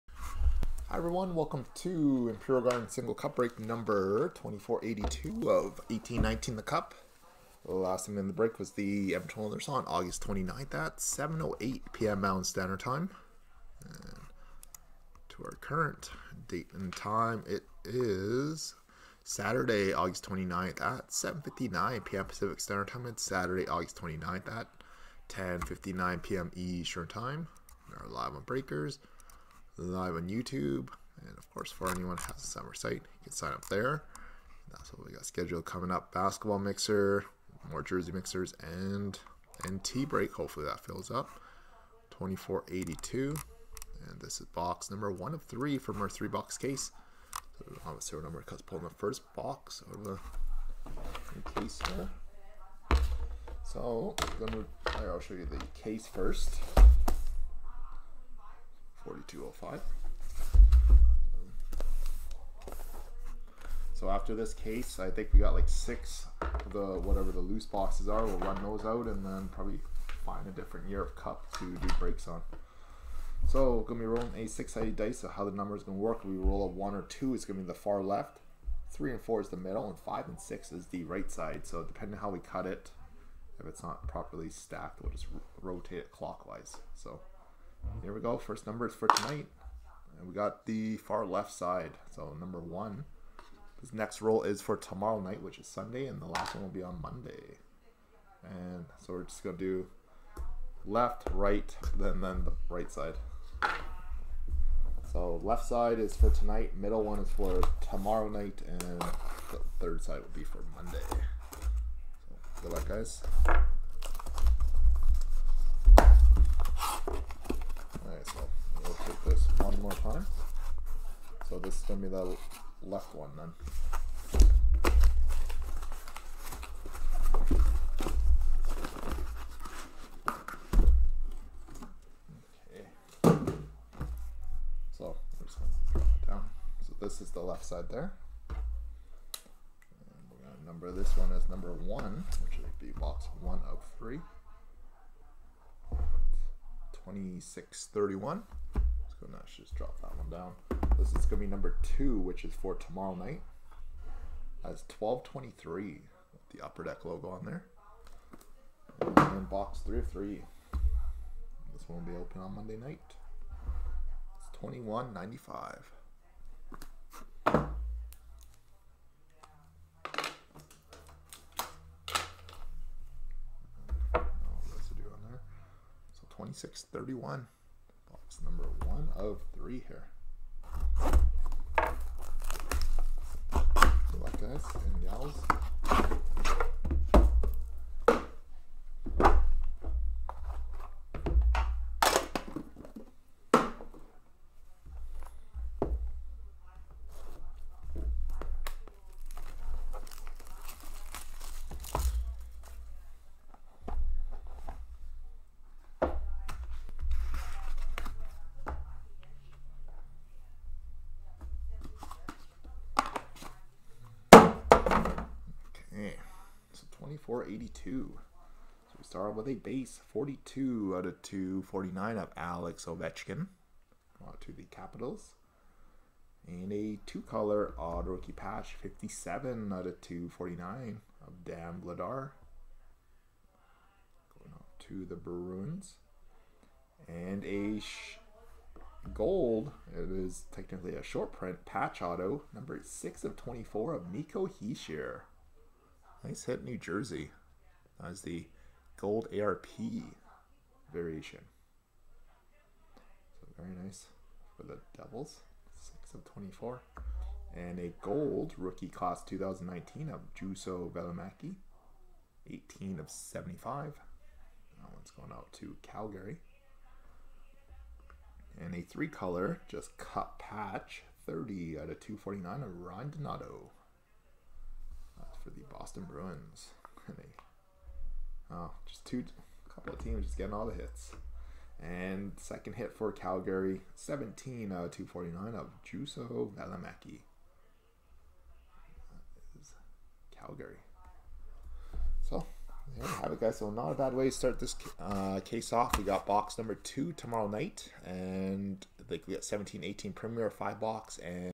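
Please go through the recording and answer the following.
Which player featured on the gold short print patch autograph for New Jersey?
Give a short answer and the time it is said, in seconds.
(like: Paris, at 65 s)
Nico Hischier, at 244 s.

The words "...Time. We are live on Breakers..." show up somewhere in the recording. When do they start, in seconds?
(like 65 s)
27 s.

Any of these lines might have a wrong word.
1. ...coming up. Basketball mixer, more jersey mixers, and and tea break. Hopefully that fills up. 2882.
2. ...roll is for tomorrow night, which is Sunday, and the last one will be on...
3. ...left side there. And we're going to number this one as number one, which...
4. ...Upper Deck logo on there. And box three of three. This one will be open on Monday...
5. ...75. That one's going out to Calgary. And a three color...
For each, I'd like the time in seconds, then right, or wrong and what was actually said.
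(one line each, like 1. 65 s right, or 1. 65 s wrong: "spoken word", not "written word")
1. 35 s wrong: "2482", not "2882"
2. 94 s right
3. 137 s right
4. 156 s right
5. 263 s right.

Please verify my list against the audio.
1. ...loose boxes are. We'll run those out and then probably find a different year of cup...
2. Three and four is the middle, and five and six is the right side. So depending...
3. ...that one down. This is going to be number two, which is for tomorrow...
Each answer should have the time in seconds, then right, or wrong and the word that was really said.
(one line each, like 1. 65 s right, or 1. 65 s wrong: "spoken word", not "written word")
1. 67 s right
2. 78 s right
3. 150 s right.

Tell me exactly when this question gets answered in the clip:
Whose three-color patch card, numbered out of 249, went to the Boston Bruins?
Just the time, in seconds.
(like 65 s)
272 s.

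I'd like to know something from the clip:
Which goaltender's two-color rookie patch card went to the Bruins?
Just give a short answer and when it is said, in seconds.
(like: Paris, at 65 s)
Dan Vladar, at 231 s.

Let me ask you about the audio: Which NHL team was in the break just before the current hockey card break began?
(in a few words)
Edmonton Oilers.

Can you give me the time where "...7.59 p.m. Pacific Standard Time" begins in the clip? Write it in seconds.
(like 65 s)
21 s.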